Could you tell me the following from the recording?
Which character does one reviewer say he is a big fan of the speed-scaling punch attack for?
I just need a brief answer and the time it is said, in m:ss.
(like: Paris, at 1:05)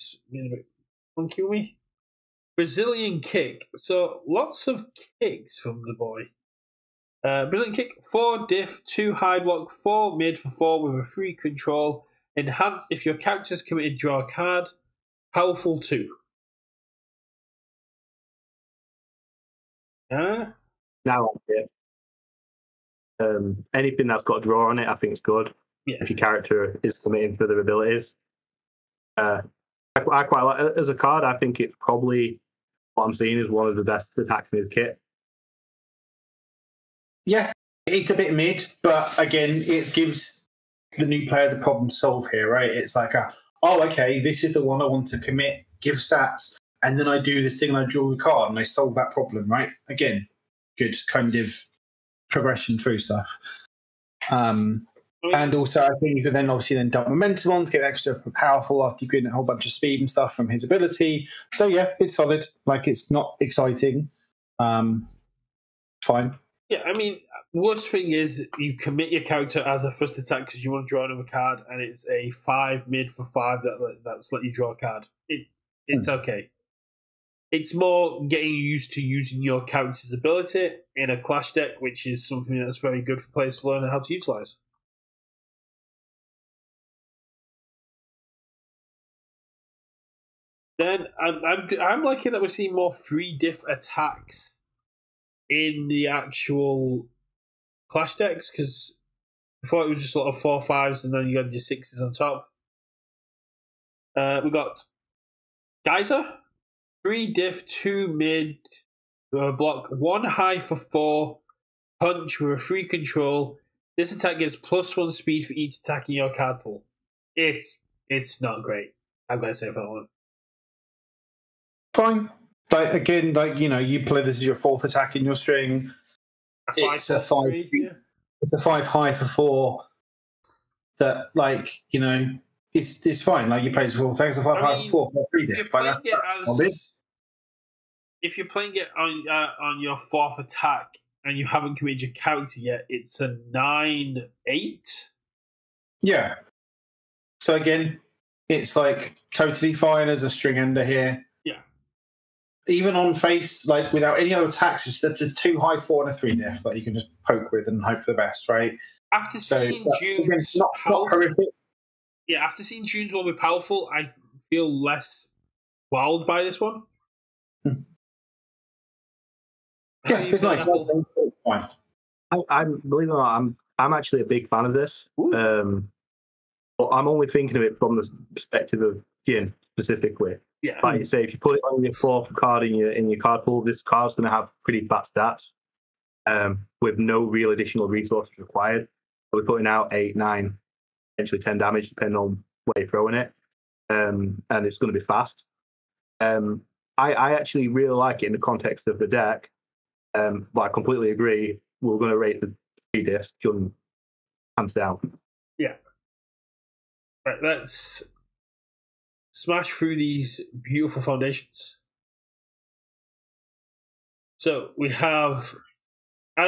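Jin, at 2:59.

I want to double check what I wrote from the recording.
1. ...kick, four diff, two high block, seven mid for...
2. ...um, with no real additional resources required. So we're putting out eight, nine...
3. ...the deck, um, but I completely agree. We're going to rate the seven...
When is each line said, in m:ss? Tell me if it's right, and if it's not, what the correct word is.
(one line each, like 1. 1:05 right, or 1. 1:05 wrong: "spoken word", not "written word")
1. 0:07 wrong: "four", not "seven"
2. 3:06 right
3. 3:18 wrong: "three", not "seven".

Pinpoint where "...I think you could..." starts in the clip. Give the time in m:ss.
0:55.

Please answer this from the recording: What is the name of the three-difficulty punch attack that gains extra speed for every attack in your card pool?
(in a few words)
Geyser.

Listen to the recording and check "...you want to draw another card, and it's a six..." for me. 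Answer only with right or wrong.
wrong.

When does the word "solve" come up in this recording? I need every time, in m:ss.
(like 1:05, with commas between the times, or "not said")
0:41, 0:48.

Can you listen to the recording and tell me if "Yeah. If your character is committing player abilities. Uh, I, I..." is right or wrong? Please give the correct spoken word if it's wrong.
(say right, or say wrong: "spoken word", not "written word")
wrong: "further", not "player".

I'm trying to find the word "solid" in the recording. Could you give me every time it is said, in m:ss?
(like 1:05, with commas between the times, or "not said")
1:02, 2:16.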